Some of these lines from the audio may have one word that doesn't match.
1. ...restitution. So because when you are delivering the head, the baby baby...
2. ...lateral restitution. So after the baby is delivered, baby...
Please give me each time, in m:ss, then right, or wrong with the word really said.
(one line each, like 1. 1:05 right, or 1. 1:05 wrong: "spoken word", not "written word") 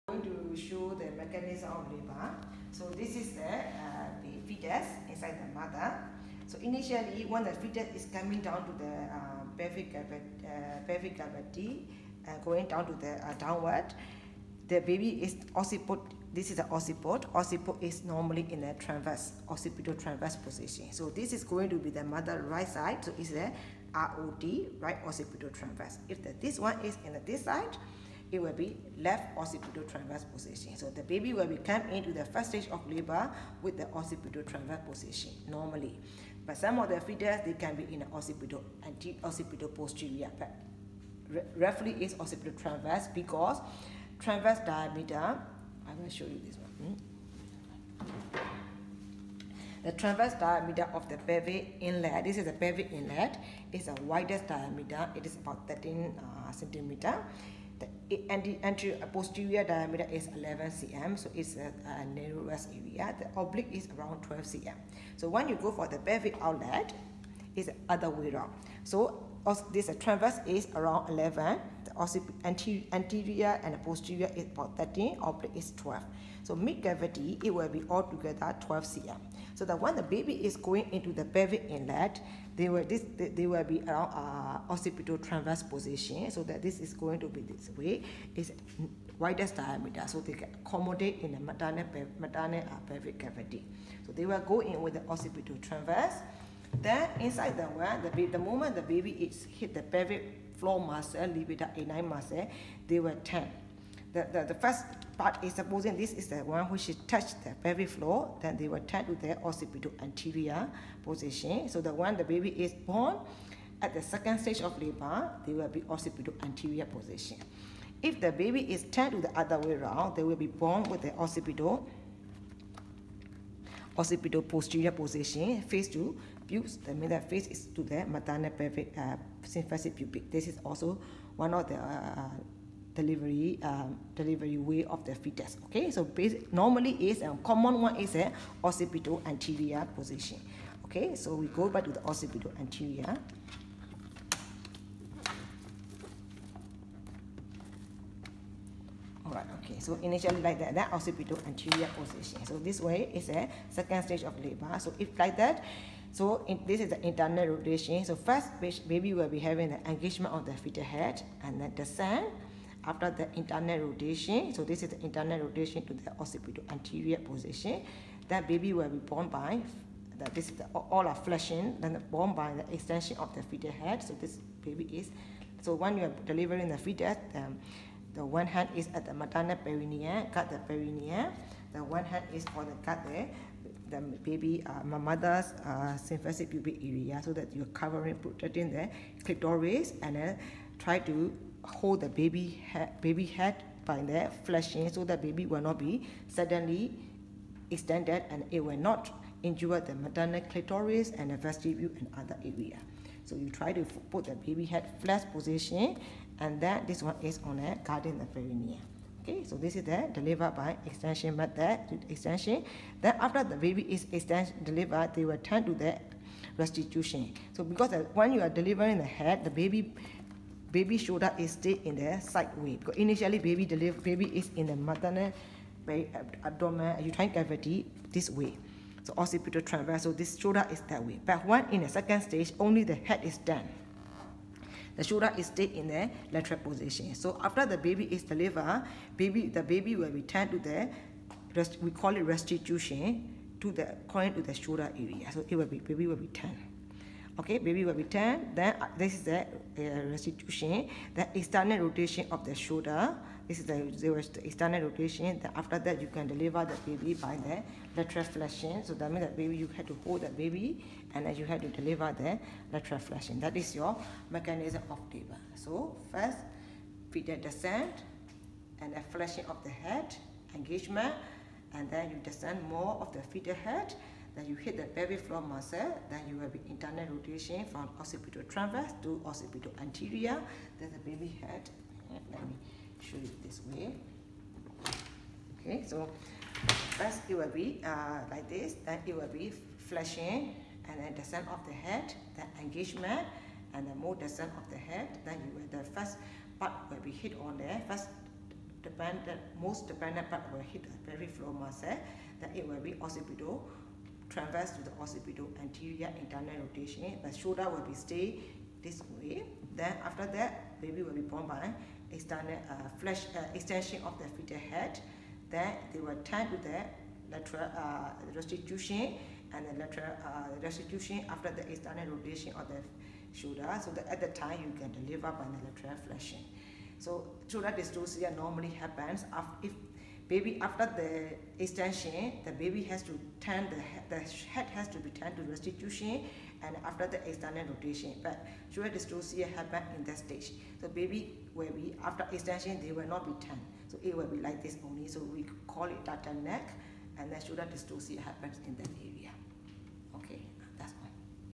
1. 3:36 right
2. 3:56 wrong: "position", not "restitution".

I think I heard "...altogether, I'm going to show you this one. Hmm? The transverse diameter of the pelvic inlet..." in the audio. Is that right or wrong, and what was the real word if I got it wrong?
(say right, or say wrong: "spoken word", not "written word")
wrong: "diameter", not "altogether".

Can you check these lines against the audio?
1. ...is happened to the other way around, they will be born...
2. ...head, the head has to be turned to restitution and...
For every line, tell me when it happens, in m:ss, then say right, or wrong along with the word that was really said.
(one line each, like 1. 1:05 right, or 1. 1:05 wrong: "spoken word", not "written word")
1. 1:58 wrong: "turned", not "happened"
2. 5:33 right.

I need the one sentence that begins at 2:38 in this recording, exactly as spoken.
So first baby will be having the engagement of the fetal head and then descend.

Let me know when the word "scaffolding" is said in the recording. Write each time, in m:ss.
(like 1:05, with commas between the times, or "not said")
not said.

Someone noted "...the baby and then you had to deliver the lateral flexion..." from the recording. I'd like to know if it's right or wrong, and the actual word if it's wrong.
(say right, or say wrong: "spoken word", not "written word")
right.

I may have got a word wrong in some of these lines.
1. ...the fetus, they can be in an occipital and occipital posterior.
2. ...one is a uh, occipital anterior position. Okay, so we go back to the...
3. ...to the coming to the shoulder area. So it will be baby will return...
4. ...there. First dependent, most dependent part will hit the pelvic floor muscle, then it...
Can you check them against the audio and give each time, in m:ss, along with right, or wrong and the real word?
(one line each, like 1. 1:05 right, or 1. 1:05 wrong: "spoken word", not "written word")
1. 0:36 right
2. 2:17 right
3. 4:03 wrong: "according", not "coming"
4. 4:57 right.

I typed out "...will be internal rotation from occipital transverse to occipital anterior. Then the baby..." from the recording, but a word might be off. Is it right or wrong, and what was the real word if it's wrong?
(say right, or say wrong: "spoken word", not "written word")
right.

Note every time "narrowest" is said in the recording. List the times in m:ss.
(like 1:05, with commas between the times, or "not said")
1:02.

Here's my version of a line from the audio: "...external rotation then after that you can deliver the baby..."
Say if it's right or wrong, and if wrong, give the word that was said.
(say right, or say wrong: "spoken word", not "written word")
right.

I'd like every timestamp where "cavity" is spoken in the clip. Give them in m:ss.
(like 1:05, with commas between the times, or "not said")
0:11, 1:16, 1:33, 3:47.